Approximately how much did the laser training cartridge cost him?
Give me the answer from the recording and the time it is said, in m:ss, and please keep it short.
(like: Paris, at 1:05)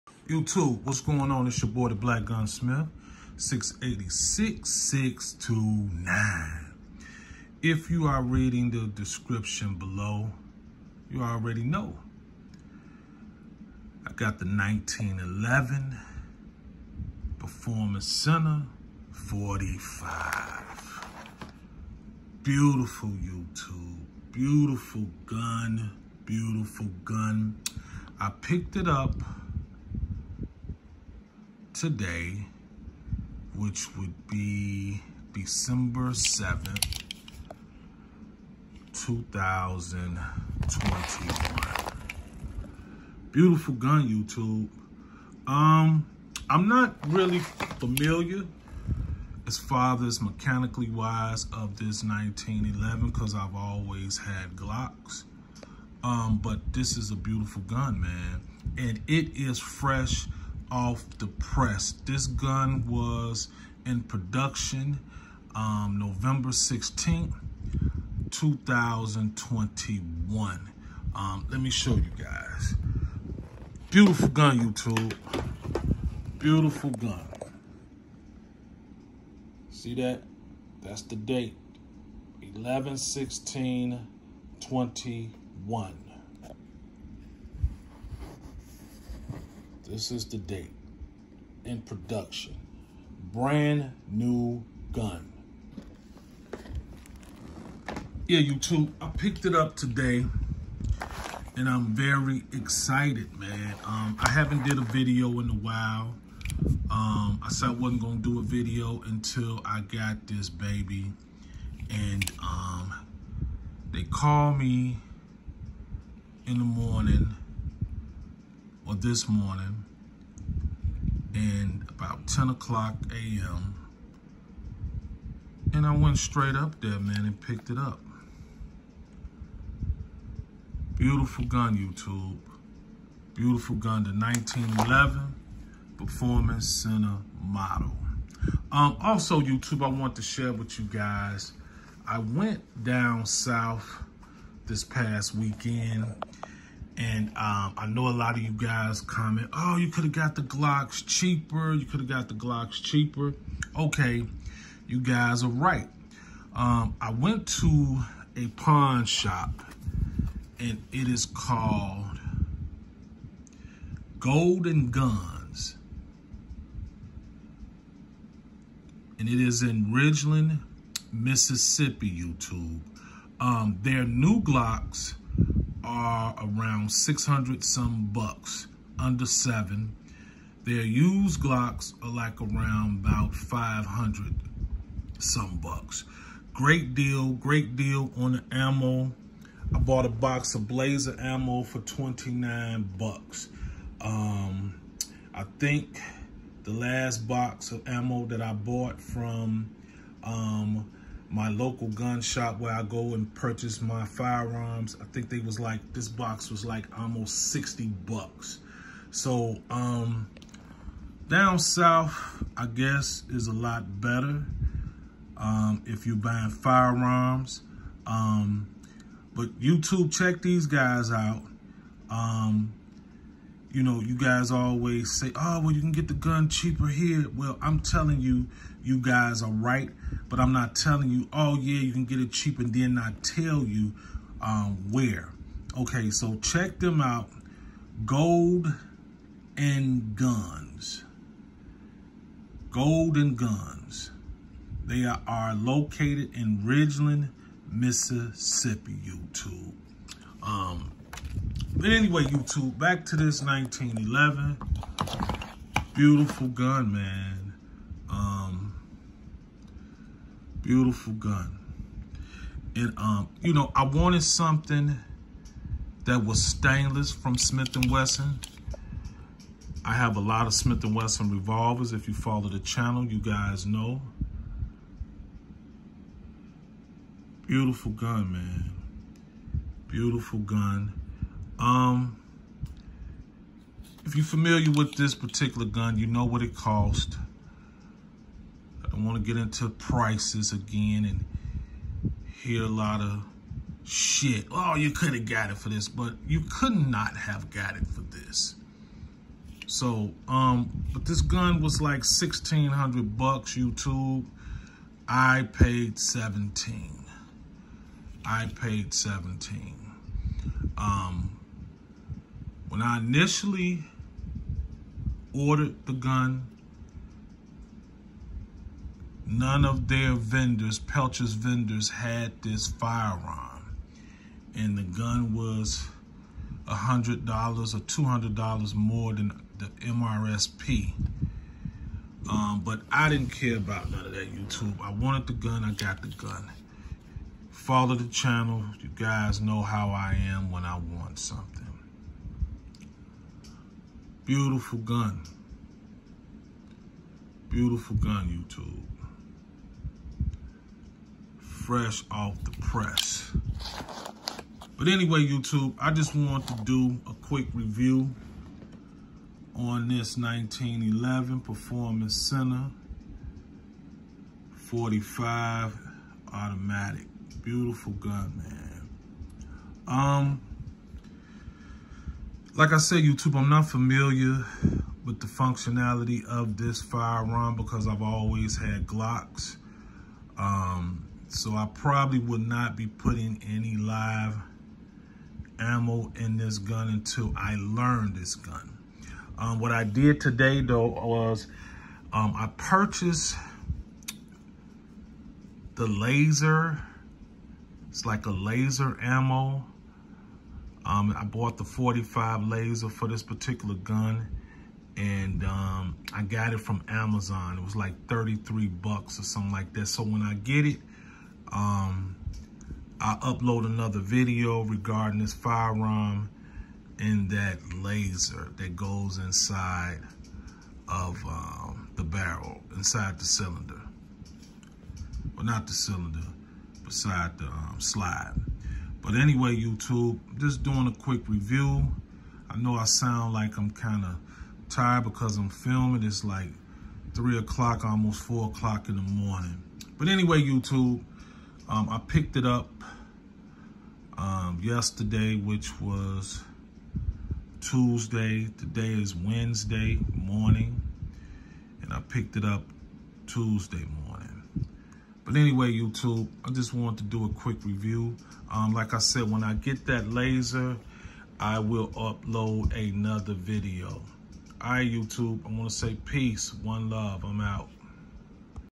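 $33, at 6:48.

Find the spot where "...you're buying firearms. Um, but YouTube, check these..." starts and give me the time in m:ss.
3:36.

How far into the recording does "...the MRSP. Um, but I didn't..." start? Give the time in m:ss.
5:29.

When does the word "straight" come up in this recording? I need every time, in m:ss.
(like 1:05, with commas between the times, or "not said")
2:06.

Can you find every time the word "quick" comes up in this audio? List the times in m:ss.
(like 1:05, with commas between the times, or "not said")
5:57, 7:10, 7:37.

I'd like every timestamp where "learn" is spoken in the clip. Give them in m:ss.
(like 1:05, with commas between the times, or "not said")
6:27.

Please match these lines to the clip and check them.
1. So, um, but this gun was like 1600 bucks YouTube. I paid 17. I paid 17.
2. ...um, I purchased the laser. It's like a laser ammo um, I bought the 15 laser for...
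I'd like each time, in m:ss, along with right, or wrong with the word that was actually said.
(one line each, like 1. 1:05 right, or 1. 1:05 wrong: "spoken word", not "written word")
1. 4:59 right
2. 6:32 wrong: "45", not "15".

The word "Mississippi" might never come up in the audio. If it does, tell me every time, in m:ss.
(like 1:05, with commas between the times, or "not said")
2:51, 4:07.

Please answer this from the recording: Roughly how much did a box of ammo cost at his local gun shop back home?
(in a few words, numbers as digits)
almost $60.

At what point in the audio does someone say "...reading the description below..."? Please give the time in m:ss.
0:08.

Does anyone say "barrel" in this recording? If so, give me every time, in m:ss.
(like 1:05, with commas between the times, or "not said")
7:02.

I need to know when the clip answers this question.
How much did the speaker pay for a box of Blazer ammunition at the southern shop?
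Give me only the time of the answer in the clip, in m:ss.
3:11.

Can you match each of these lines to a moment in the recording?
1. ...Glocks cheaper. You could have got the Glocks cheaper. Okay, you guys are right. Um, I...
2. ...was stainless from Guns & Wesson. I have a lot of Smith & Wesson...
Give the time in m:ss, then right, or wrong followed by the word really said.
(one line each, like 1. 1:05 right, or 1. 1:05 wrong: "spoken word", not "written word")
1. 2:30 right
2. 4:26 wrong: "Smith", not "Guns".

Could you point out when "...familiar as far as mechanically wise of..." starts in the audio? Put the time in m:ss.
0:47.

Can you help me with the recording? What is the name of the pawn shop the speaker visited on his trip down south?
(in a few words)
Golden Guns.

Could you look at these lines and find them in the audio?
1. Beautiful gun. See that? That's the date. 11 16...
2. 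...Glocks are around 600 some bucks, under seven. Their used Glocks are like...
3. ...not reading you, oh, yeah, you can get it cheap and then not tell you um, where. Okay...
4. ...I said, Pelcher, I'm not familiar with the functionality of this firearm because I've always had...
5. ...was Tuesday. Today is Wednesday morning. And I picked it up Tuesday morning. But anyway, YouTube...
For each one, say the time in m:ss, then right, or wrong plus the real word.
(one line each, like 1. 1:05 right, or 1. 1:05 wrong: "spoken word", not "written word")
1. 1:16 right
2. 2:54 right
3. 3:50 wrong: "telling", not "reading"
4. 6:12 wrong: "YouTube", not "Pelcher"
5. 7:25 right.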